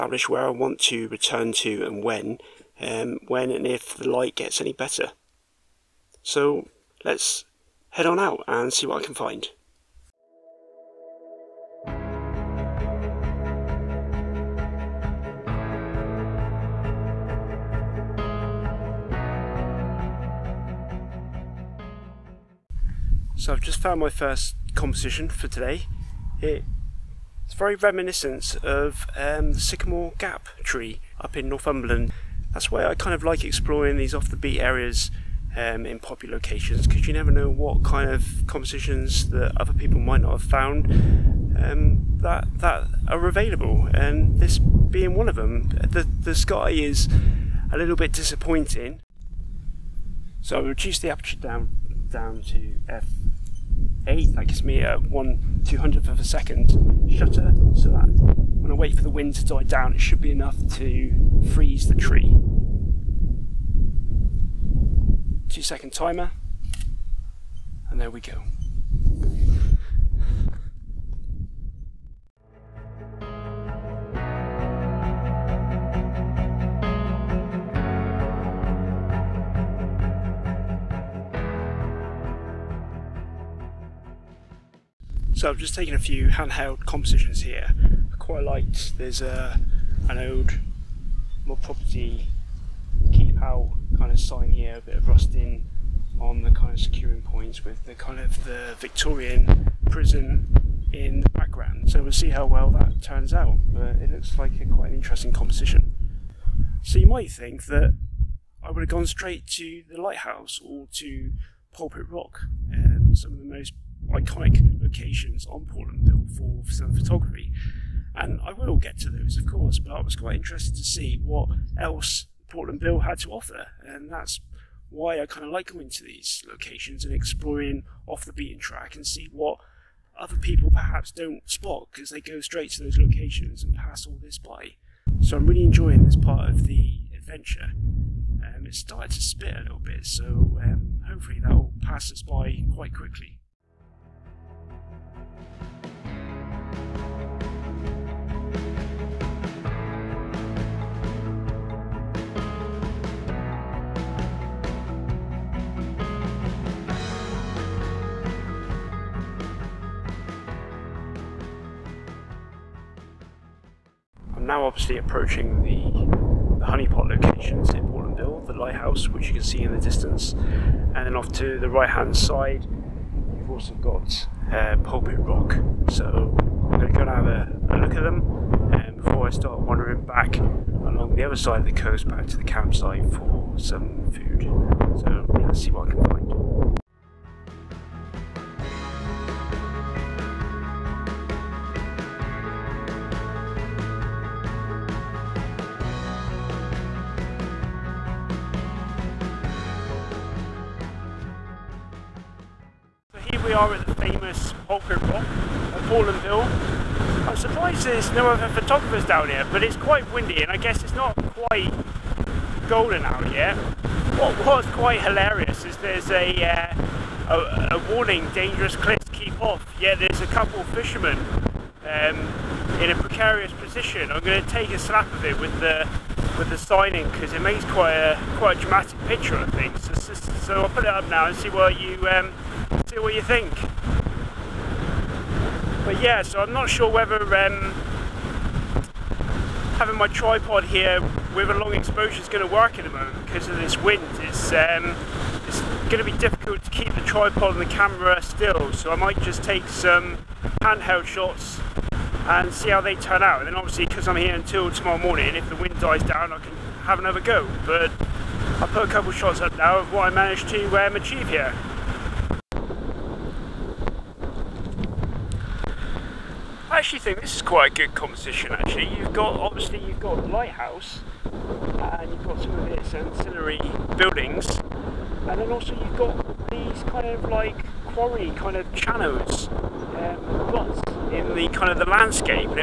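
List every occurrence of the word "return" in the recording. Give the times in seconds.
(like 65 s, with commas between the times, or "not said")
1 s.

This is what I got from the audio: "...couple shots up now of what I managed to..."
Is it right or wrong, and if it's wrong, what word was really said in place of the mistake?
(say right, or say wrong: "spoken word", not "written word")
right.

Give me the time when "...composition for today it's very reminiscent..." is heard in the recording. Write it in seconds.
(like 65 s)
24 s.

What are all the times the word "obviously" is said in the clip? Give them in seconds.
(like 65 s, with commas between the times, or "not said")
164 s, 253 s, 269 s.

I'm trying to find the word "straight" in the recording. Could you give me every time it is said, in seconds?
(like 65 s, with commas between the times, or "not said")
109 s, 132 s.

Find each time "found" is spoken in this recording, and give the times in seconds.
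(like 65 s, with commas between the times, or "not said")
23 s, 40 s.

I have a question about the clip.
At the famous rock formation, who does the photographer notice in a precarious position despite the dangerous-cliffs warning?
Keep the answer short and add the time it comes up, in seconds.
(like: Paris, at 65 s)
fishermen, at 220 s.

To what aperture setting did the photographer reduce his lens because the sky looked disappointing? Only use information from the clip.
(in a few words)
f8.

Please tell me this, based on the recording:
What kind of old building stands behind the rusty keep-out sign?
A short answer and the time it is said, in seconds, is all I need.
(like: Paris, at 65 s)
Victorian prison, at 98 s.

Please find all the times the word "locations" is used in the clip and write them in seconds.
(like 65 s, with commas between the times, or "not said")
36 s, 114 s, 126 s, 132 s, 167 s.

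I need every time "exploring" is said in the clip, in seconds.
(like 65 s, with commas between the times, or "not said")
33 s, 127 s.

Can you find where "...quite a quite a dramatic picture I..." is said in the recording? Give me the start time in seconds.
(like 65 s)
227 s.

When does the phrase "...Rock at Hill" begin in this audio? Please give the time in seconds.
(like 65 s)
205 s.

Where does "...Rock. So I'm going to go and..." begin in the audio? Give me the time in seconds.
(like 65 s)
175 s.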